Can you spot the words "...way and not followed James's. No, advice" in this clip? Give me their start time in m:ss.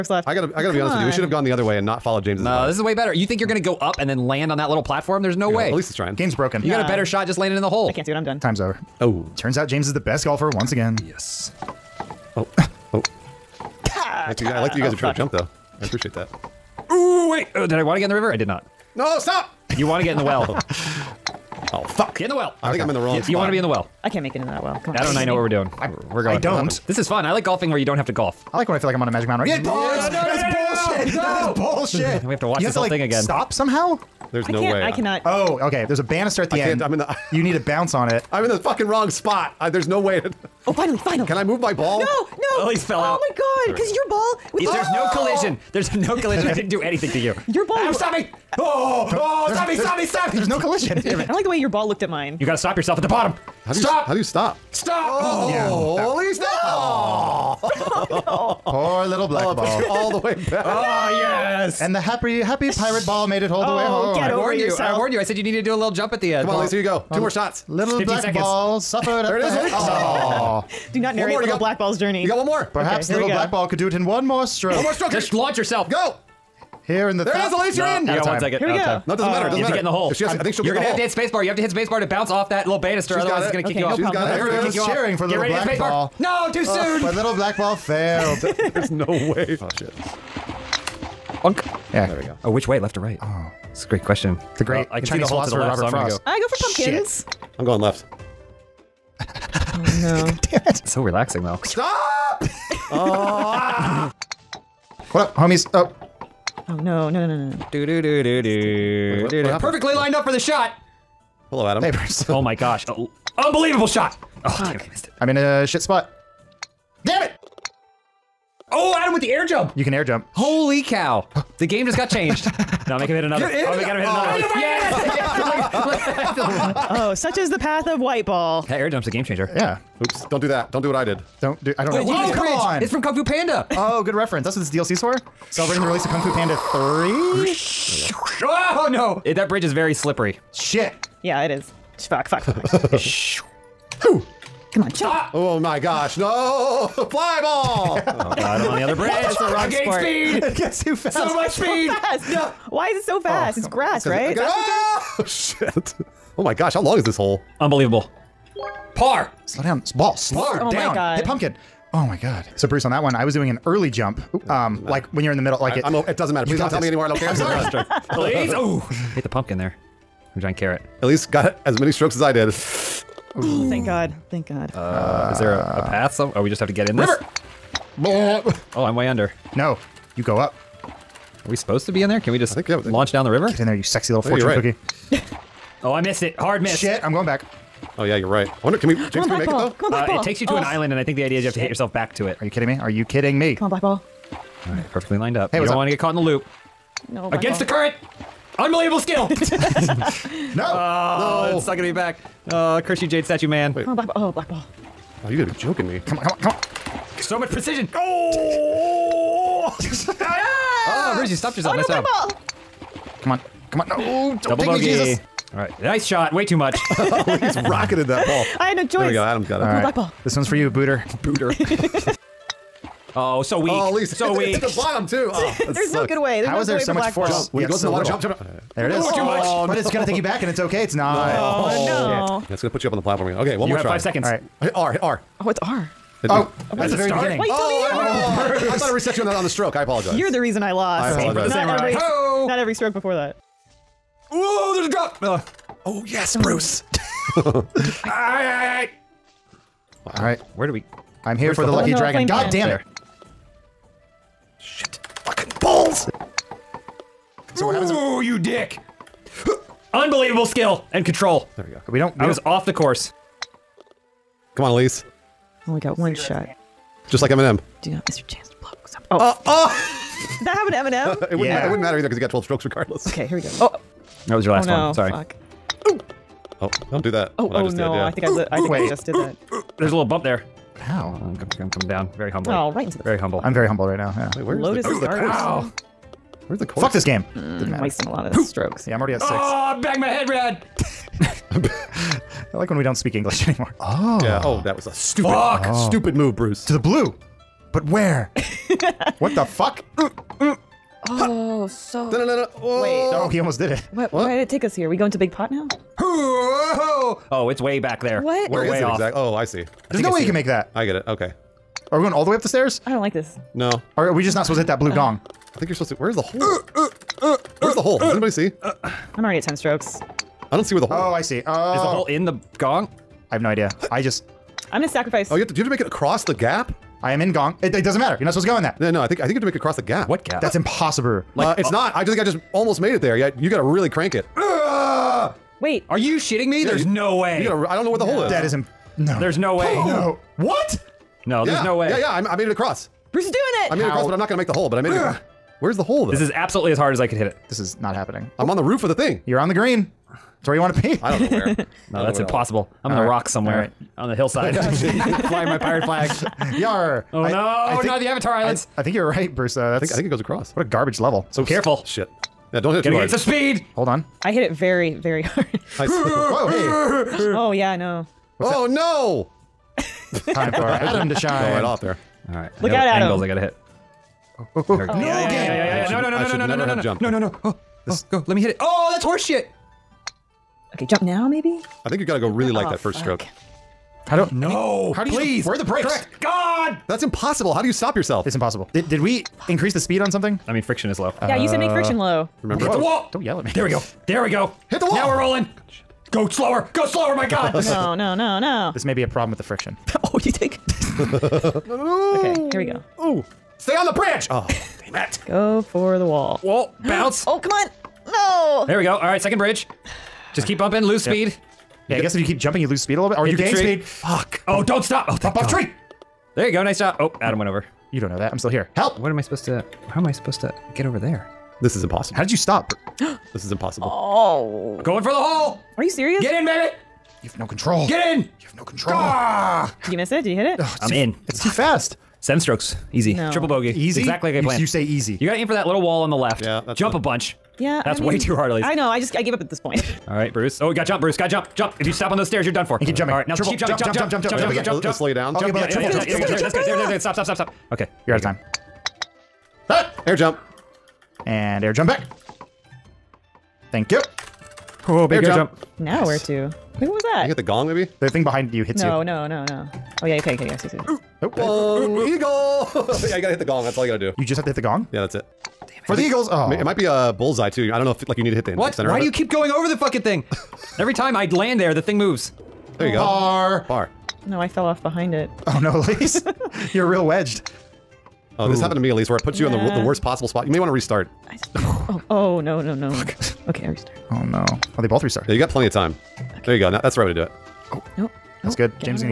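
0:01.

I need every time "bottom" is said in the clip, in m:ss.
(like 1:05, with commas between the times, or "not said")
0:53, 3:44.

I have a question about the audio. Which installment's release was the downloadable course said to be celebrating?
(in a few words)
Kung Fu Panda Three.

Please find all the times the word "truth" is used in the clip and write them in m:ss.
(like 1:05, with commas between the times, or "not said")
not said.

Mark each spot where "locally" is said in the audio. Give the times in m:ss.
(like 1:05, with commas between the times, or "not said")
not said.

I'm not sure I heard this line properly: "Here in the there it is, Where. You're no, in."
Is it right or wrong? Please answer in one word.
wrong.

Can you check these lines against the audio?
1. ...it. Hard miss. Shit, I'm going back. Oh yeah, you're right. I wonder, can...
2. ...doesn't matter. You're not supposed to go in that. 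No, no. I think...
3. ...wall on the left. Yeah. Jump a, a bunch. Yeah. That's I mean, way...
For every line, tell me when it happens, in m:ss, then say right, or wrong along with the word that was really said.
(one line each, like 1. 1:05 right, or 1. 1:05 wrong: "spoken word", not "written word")
1. 3:06 right
2. 5:27 right
3. 7:15 right.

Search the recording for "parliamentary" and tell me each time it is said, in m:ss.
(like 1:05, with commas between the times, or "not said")
not said.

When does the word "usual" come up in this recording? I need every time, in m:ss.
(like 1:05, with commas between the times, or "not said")
not said.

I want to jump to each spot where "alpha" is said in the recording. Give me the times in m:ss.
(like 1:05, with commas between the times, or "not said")
not said.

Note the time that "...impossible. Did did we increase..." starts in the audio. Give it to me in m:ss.
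6:28.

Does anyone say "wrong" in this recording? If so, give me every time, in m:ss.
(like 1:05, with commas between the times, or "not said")
0:22, 0:38, 2:29.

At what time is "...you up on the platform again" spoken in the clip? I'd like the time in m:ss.
3:52.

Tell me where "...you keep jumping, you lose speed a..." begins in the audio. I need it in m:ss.
6:52.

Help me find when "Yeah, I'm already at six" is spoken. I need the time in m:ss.
4:48.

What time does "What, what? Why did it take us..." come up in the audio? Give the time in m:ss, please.
5:03.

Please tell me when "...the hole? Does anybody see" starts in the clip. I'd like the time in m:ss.
5:17.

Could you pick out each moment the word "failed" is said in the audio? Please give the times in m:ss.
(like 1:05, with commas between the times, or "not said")
1:27.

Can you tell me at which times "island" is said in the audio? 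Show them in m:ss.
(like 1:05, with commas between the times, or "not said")
3:10, 5:58.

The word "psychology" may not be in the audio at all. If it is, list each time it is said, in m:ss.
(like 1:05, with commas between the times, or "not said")
not said.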